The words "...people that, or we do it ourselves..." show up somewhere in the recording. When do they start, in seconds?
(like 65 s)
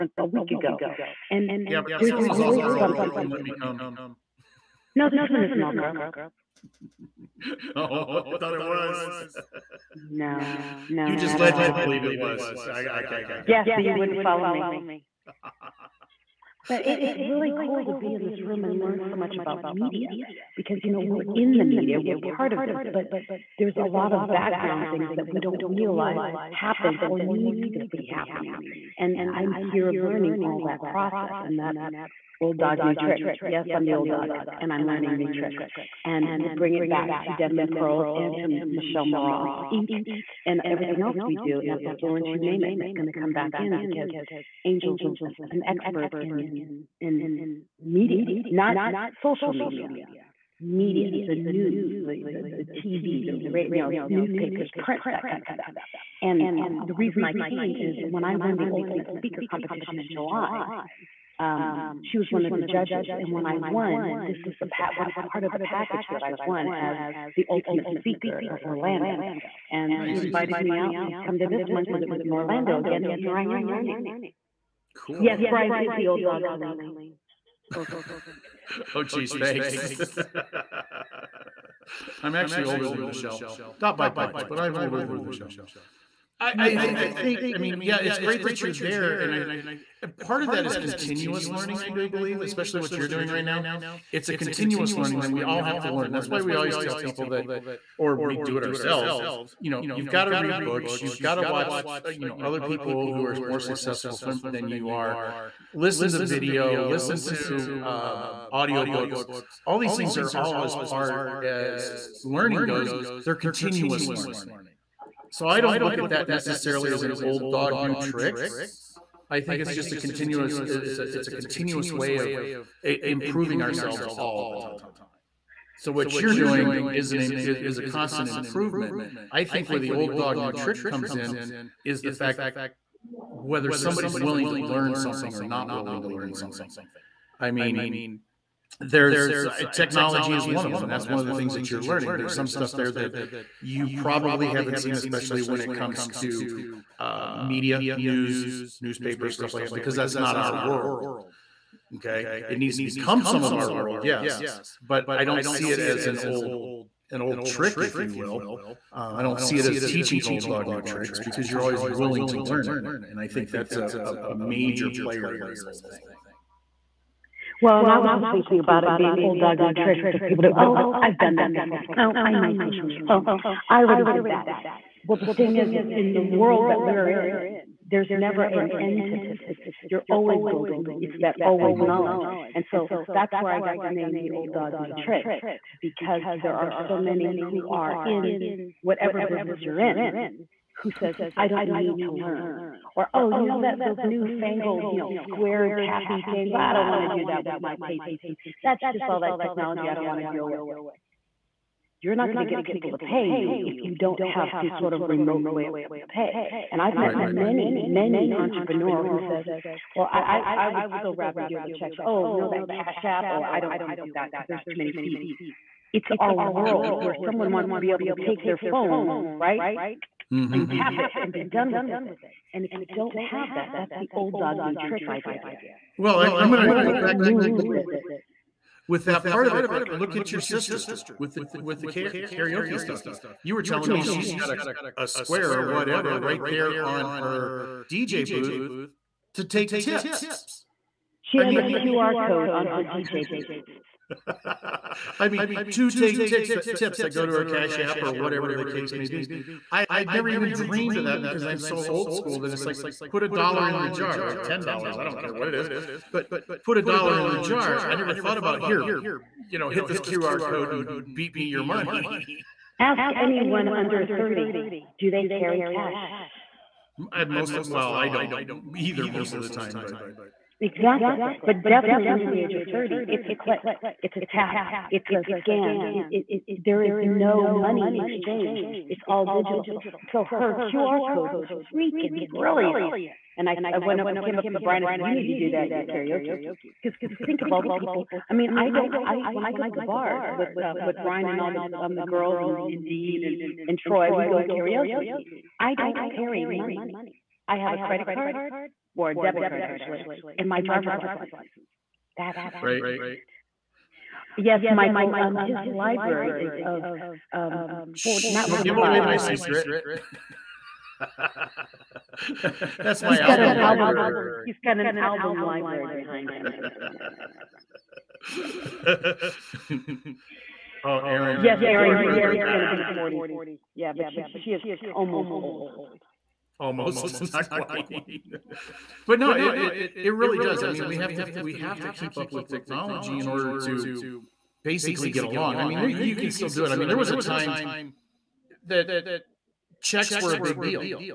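96 s.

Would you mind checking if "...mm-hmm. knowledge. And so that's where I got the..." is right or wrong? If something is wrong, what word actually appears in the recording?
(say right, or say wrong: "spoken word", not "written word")
right.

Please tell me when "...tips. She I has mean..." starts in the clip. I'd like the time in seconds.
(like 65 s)
239 s.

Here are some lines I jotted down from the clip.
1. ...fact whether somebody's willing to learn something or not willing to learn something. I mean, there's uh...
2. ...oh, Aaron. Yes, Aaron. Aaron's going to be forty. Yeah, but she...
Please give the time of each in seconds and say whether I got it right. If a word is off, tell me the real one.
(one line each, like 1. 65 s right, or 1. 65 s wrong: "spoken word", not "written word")
1. 132 s right
2. 320 s right.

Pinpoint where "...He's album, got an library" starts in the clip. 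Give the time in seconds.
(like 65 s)
313 s.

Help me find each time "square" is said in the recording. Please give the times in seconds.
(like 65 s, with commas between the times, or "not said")
195 s, 235 s.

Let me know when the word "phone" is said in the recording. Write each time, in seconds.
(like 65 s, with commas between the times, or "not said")
218 s.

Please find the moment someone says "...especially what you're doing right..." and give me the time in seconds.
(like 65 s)
92 s.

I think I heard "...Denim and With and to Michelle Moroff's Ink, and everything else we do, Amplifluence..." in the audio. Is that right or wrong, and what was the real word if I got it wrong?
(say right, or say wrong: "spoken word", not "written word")
wrong: "Pearls", not "With".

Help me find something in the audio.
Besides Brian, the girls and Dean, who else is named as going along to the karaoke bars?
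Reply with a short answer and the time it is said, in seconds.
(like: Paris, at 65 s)
Troy, at 293 s.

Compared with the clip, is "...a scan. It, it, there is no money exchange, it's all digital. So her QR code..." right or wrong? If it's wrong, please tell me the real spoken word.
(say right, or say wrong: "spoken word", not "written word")
right.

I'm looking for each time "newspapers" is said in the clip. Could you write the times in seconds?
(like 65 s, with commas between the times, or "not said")
54 s, 148 s.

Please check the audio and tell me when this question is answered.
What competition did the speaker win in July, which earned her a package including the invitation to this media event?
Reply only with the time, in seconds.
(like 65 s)
58 s.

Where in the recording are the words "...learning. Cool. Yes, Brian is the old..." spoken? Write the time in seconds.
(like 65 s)
73 s.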